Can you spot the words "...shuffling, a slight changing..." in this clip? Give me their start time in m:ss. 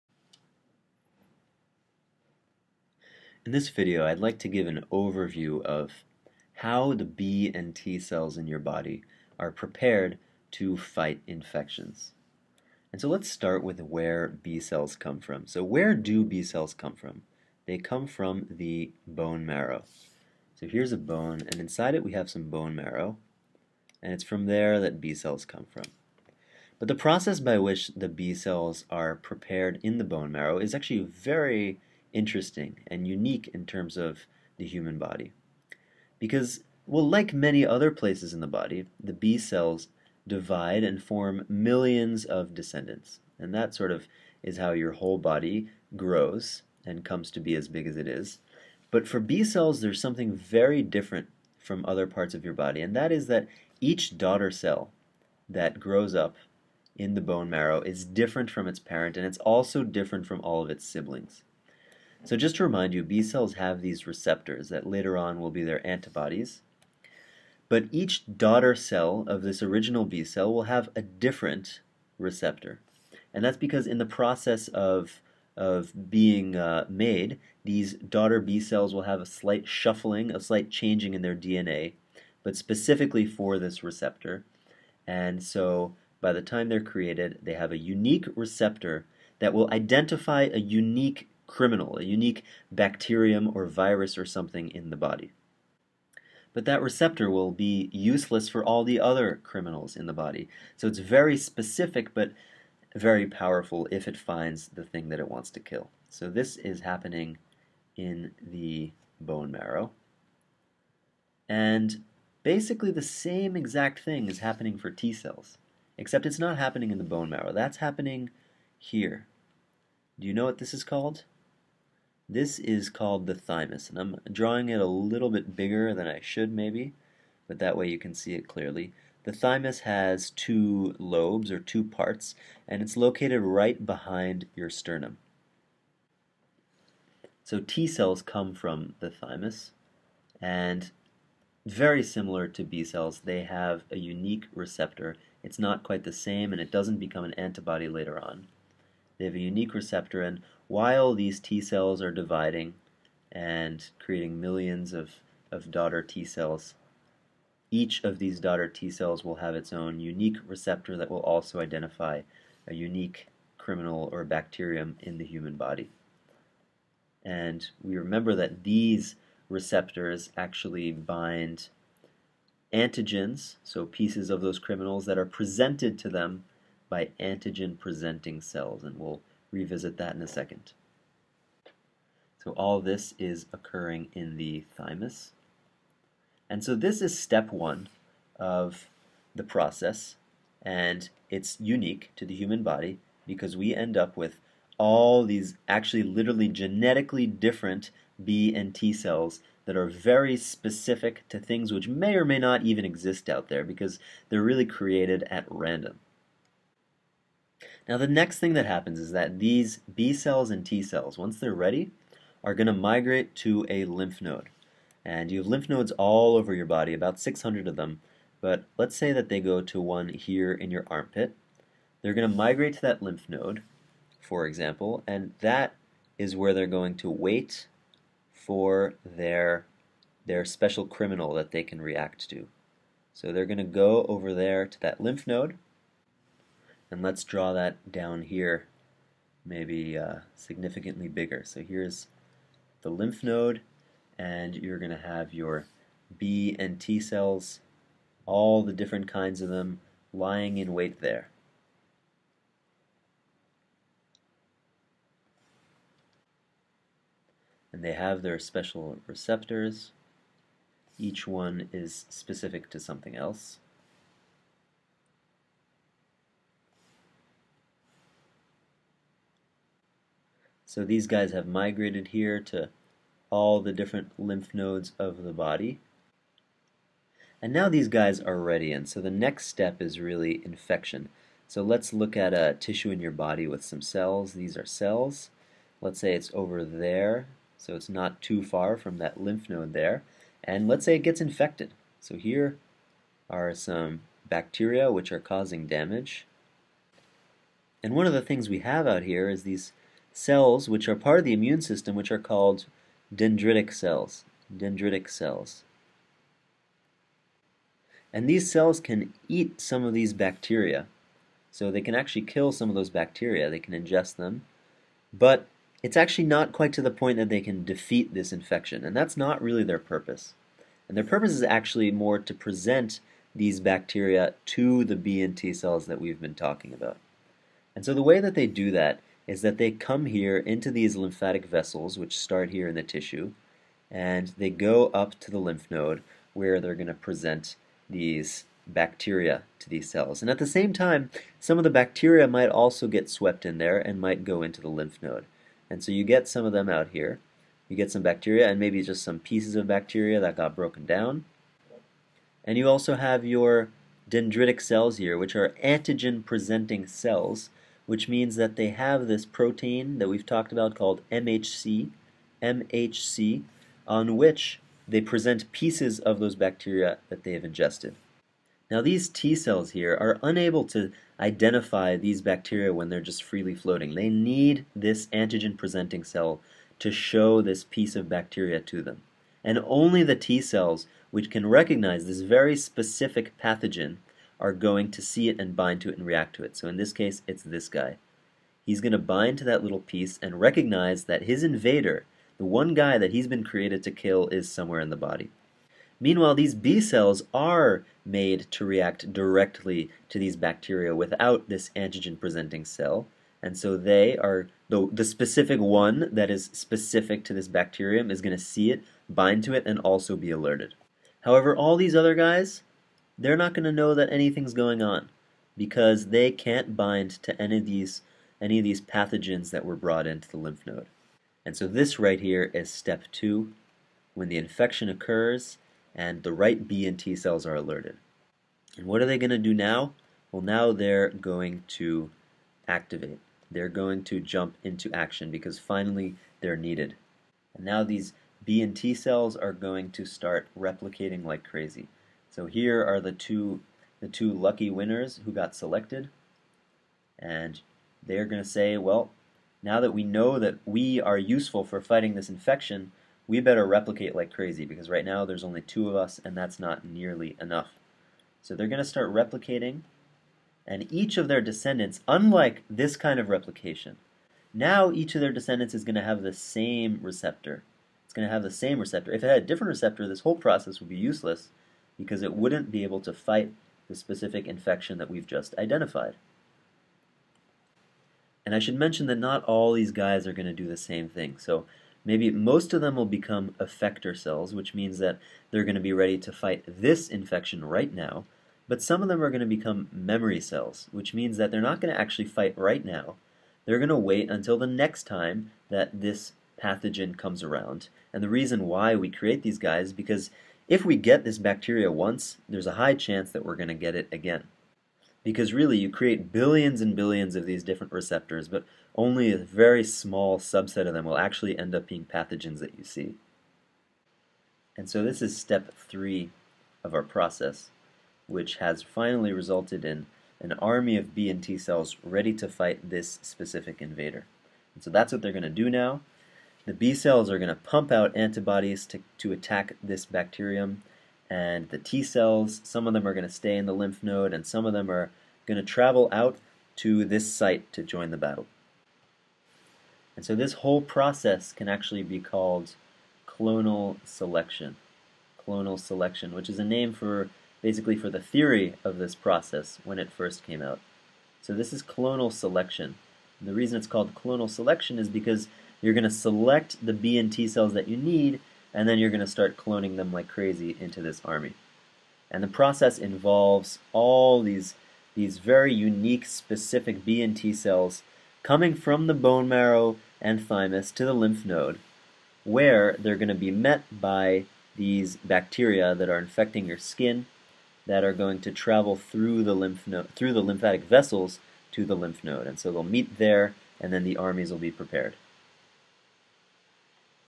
1:19.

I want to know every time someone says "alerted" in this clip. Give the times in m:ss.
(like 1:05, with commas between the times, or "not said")
6:50, 7:07.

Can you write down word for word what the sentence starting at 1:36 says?
But that receptor will be useless for all the other criminals in the body.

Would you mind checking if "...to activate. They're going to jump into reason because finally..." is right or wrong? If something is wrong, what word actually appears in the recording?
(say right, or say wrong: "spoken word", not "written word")
wrong: "action", not "reason".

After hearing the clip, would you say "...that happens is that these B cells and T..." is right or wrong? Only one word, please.
right.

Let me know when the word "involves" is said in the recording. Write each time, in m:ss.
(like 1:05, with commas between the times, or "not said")
9:22.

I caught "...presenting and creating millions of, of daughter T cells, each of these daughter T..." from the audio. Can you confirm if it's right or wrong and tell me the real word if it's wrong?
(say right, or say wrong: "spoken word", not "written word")
wrong: "dividing", not "presenting".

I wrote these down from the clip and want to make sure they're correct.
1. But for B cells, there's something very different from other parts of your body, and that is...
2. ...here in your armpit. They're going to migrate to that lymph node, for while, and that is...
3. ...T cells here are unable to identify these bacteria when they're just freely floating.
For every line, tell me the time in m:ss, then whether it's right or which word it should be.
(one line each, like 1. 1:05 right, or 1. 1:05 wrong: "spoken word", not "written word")
1. 0:48 right
2. 3:40 wrong: "example", not "while"
3. 6:09 right.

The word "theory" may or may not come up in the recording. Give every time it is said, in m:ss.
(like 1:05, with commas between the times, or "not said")
9:08.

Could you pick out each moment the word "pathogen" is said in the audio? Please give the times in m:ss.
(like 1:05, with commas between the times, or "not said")
6:23, 6:58, 8:16, 8:32.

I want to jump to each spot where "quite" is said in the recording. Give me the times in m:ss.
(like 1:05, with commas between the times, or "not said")
2:25, 5:16.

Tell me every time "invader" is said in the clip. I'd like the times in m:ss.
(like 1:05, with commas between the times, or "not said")
6:31, 8:43.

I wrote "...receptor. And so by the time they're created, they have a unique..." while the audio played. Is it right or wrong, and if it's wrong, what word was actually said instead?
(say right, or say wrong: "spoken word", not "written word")
right.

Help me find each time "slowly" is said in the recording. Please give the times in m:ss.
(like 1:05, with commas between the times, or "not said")
not said.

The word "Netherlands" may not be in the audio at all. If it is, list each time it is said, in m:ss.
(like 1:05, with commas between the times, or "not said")
not said.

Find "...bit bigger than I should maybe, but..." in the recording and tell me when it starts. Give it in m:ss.
2:05.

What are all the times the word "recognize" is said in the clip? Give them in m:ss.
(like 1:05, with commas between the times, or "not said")
6:21, 6:30.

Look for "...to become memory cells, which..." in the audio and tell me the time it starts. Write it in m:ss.
8:09.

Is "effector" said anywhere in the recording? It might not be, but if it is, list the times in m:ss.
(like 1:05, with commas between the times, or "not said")
8:03.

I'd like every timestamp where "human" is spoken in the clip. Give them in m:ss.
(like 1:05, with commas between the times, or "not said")
0:34, 2:45, 3:12.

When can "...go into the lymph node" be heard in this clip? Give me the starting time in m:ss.
5:44.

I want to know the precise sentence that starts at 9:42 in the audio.
And so they'll meet there, and then the armies will be prepared.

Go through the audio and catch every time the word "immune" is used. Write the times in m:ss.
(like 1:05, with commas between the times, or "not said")
5:01.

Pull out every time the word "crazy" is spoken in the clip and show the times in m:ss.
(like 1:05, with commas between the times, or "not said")
7:21, 7:34, 9:20.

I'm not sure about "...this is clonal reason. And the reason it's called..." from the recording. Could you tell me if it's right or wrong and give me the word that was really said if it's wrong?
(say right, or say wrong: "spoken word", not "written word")
wrong: "selection", not "reason".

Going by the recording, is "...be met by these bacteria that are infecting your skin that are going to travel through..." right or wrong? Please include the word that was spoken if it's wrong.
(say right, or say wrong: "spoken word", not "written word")
right.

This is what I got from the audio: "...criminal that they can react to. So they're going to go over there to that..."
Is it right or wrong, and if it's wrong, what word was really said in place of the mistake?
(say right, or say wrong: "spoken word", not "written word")
right.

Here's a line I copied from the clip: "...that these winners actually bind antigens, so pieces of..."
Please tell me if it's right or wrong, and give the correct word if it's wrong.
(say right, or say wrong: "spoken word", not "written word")
wrong: "receptors", not "winners".